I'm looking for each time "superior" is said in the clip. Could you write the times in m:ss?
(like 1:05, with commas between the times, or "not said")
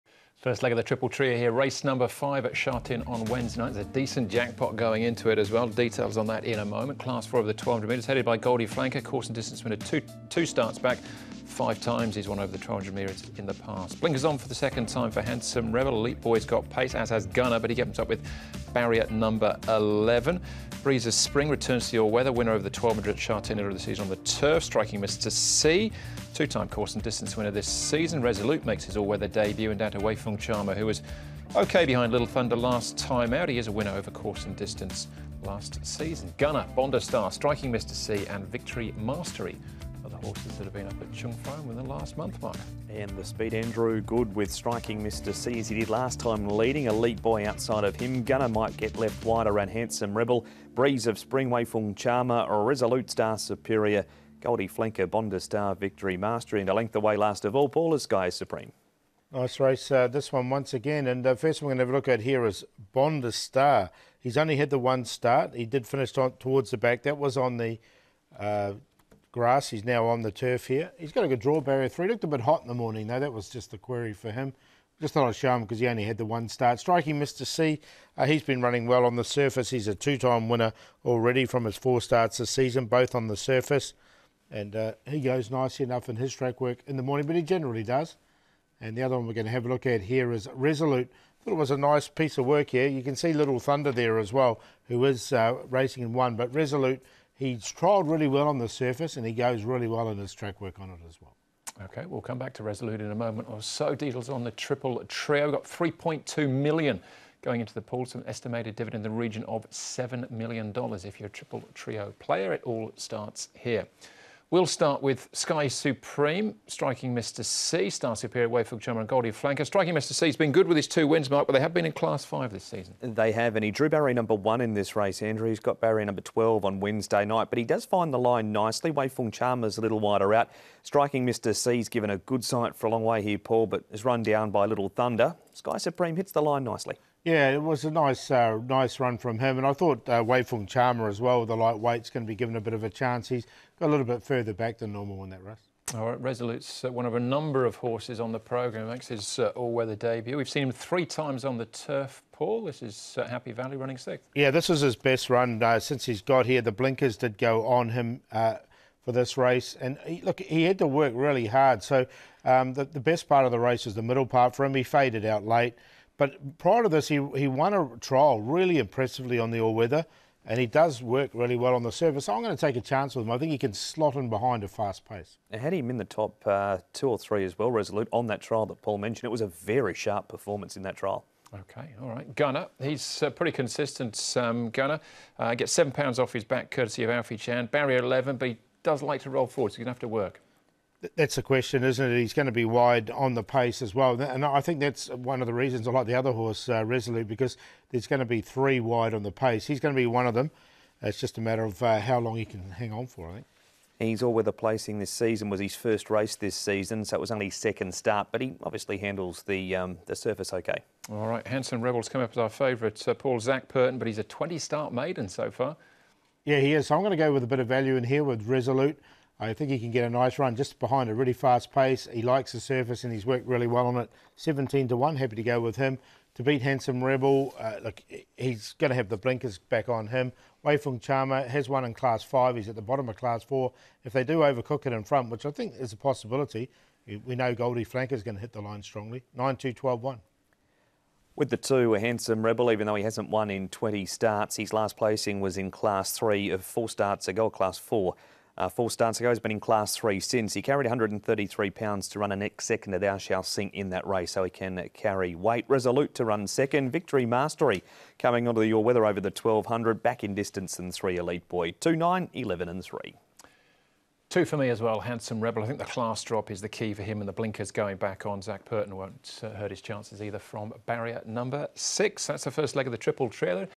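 0:53, 1:58.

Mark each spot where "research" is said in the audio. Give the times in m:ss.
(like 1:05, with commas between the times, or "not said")
not said.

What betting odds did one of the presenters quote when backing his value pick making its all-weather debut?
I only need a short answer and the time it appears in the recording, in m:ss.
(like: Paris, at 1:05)
17 to 1, at 3:44.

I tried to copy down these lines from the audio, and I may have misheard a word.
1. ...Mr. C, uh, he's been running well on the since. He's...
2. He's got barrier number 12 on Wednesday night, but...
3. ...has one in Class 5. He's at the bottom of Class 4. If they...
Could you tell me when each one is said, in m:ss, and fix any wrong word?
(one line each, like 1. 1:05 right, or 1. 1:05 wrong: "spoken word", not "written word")
1. 1:17 wrong: "surface", not "since"
2. 2:05 right
3. 3:51 right.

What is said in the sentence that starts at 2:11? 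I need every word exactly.
C's given a good sight for a long way here, Paul, but is run down by Little Thunder.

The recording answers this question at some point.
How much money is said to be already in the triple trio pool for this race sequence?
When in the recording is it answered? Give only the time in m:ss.
1:45.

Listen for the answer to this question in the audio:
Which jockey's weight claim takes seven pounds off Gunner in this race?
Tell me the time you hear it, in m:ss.
3:07.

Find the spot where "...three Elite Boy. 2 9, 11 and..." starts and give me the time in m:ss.
4:20.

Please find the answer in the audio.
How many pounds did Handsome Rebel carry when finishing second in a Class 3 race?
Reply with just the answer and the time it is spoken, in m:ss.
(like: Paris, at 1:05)
133, at 4:10.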